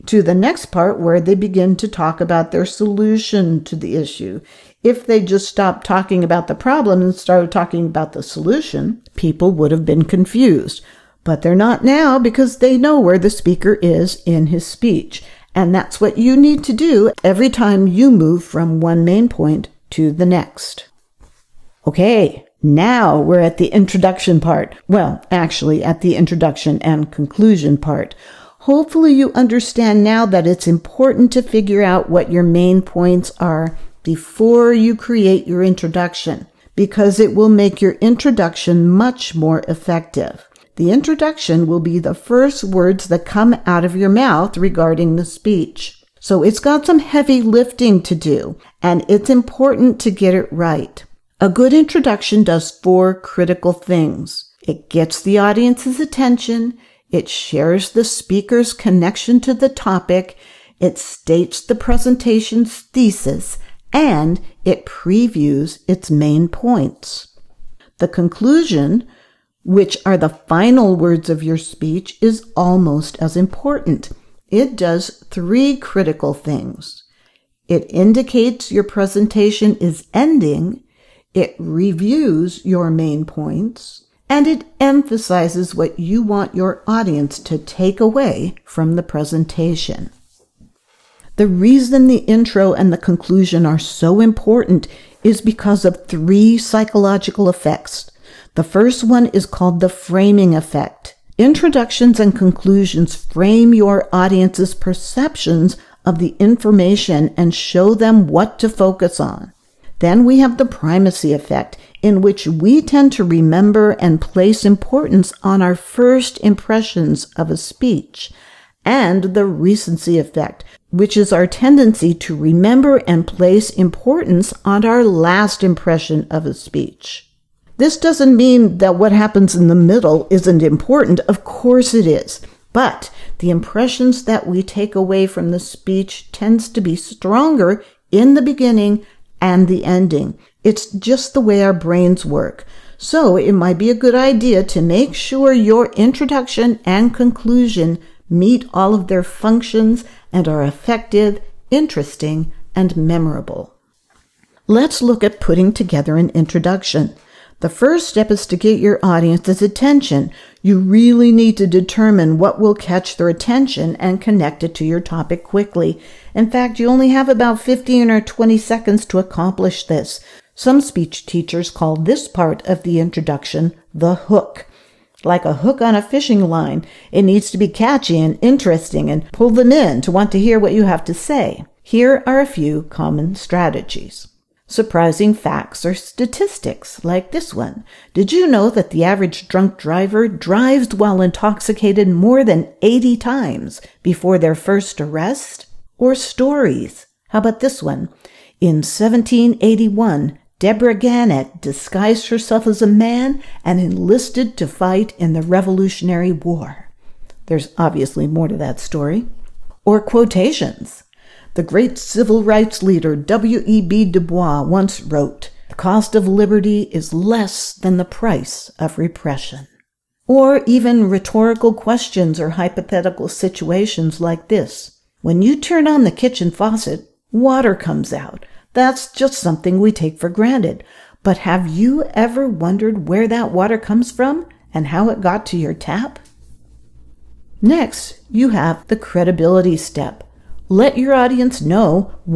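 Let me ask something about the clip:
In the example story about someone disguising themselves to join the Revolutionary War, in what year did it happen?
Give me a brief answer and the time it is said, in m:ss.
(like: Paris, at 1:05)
1781, at 3:18.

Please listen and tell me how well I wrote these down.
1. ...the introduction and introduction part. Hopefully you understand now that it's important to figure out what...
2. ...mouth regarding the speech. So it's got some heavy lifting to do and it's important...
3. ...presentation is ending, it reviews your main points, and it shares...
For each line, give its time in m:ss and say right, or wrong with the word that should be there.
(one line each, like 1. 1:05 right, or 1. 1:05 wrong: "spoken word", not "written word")
1. 0:26 wrong: "conclusion", not "introduction"
2. 0:44 right
3. 1:18 wrong: "emphasizes", not "shares".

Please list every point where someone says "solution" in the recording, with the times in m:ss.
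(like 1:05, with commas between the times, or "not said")
0:02, 0:08.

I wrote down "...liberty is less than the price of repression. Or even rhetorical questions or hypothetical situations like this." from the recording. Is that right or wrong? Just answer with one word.
right.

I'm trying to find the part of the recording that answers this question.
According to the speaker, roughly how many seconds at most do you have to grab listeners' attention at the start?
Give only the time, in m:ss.
2:48.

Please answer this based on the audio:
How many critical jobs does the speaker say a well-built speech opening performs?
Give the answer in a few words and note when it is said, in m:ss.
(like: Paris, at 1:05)
4, at 0:52.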